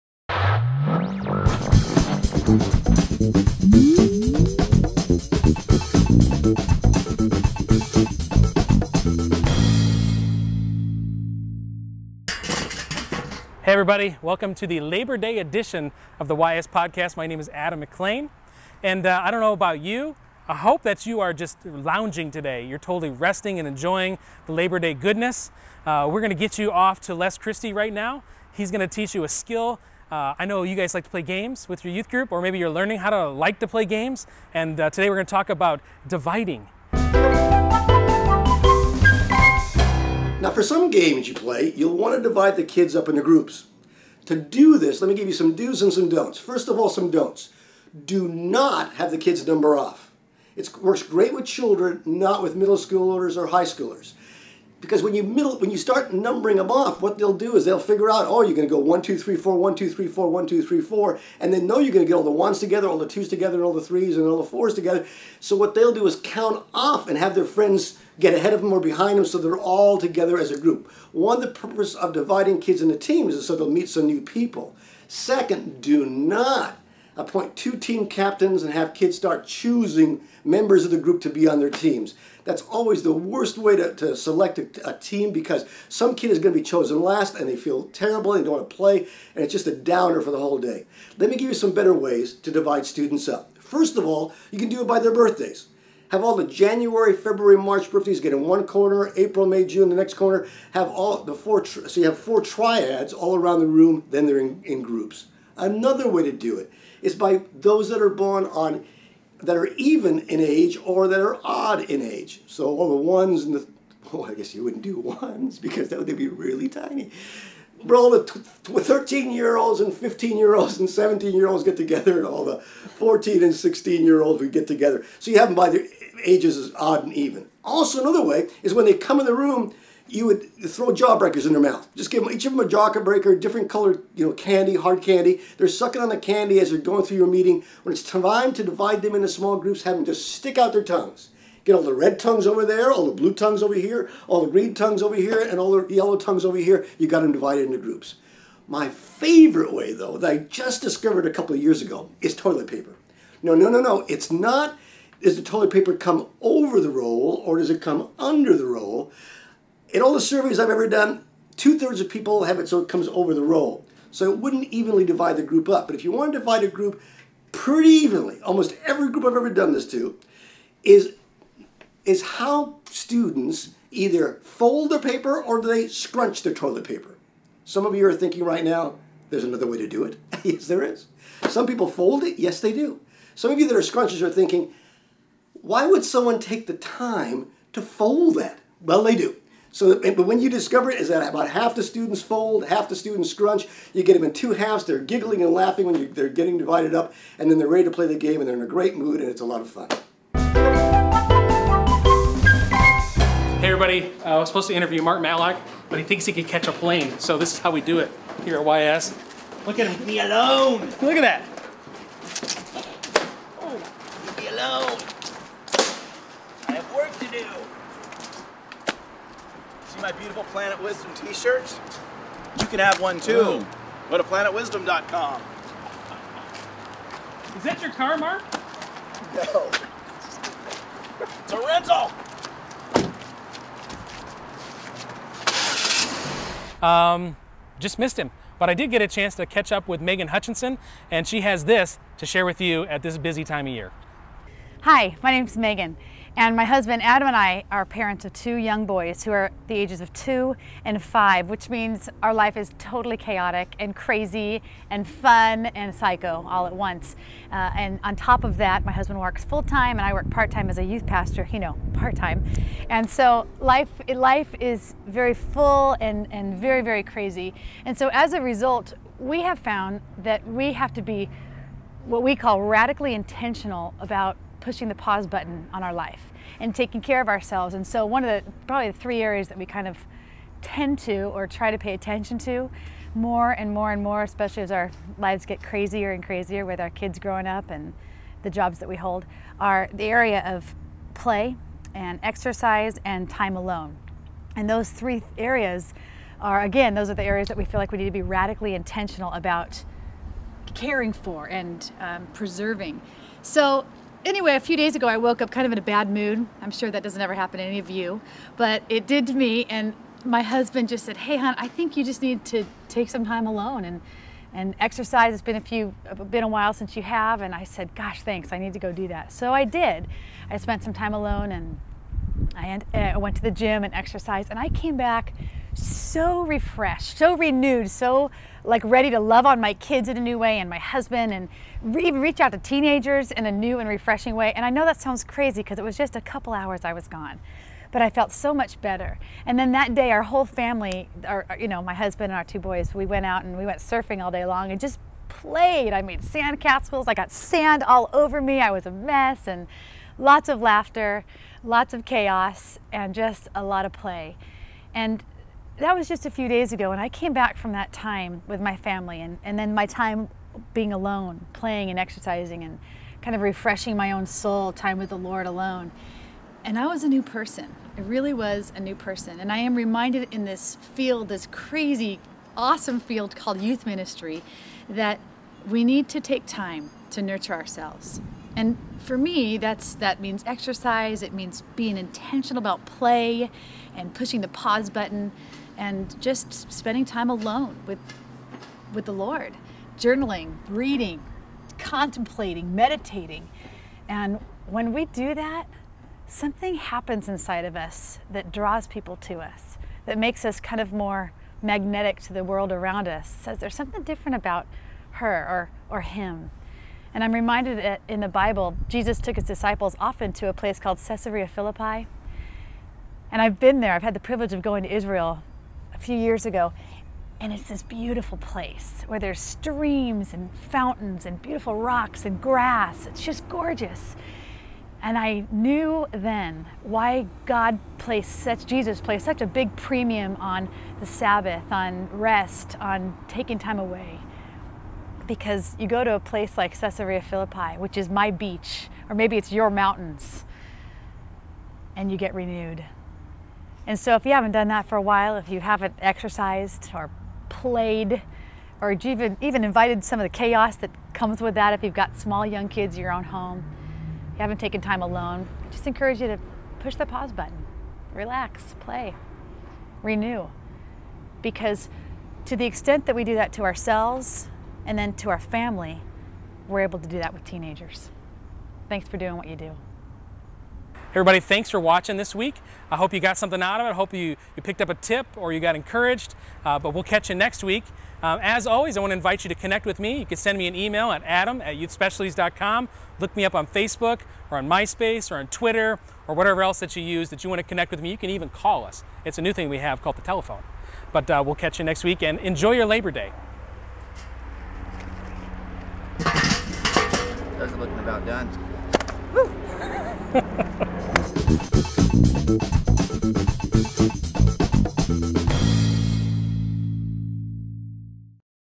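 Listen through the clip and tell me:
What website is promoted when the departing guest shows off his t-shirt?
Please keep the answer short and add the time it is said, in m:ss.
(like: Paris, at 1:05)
planetwisdom.com, at 3:44.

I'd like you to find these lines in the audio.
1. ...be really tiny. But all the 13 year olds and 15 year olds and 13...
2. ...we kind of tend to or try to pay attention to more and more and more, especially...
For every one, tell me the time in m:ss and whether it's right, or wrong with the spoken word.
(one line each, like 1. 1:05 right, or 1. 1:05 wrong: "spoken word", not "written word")
1. 1:56 wrong: "17", not "13"
2. 4:39 right.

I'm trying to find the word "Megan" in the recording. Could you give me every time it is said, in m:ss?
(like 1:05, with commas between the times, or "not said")
4:00, 4:05.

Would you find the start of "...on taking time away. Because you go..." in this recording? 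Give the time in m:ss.
7:12.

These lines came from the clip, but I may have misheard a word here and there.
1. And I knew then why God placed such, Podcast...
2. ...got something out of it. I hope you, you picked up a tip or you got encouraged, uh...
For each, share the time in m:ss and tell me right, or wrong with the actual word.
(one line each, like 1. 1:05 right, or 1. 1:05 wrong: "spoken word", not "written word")
1. 7:05 wrong: "Jesus", not "Podcast"
2. 7:53 right.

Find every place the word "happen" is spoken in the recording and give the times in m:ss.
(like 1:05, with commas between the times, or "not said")
5:07, 6:36.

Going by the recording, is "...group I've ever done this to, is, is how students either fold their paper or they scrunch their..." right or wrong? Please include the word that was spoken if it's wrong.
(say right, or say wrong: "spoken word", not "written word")
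right.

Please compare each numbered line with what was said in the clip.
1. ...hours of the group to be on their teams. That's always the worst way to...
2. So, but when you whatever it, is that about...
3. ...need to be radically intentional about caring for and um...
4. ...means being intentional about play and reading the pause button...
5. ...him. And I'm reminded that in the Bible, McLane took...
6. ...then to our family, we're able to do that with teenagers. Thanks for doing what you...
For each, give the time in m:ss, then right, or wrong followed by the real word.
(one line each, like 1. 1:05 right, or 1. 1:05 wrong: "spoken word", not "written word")
1. 1:20 wrong: "members", not "hours"
2. 3:09 wrong: "discover", not "whatever"
3. 4:57 right
4. 6:21 wrong: "pushing", not "reading"
5. 6:46 wrong: "Jesus", not "McLane"
6. 7:44 right.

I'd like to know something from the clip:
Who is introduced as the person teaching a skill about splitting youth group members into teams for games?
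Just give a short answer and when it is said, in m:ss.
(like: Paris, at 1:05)
Les Christie, at 0:27.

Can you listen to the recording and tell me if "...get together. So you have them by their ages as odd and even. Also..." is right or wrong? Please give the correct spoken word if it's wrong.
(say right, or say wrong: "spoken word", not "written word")
right.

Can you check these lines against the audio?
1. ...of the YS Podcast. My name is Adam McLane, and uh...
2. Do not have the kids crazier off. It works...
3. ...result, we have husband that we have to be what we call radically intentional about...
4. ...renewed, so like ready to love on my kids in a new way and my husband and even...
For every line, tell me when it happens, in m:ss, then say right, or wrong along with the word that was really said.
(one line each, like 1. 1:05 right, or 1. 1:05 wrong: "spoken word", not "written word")
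1. 0:16 right
2. 0:48 wrong: "number", not "crazier"
3. 4:28 wrong: "found", not "husband"
4. 5:27 right.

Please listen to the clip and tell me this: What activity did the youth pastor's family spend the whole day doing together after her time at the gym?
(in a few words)
Surfing.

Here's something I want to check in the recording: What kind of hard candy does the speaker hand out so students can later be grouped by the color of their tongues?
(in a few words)
Jawbreakers.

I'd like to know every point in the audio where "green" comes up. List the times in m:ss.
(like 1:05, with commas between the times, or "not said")
2:24.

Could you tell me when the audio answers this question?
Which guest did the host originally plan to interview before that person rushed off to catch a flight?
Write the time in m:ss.
3:25.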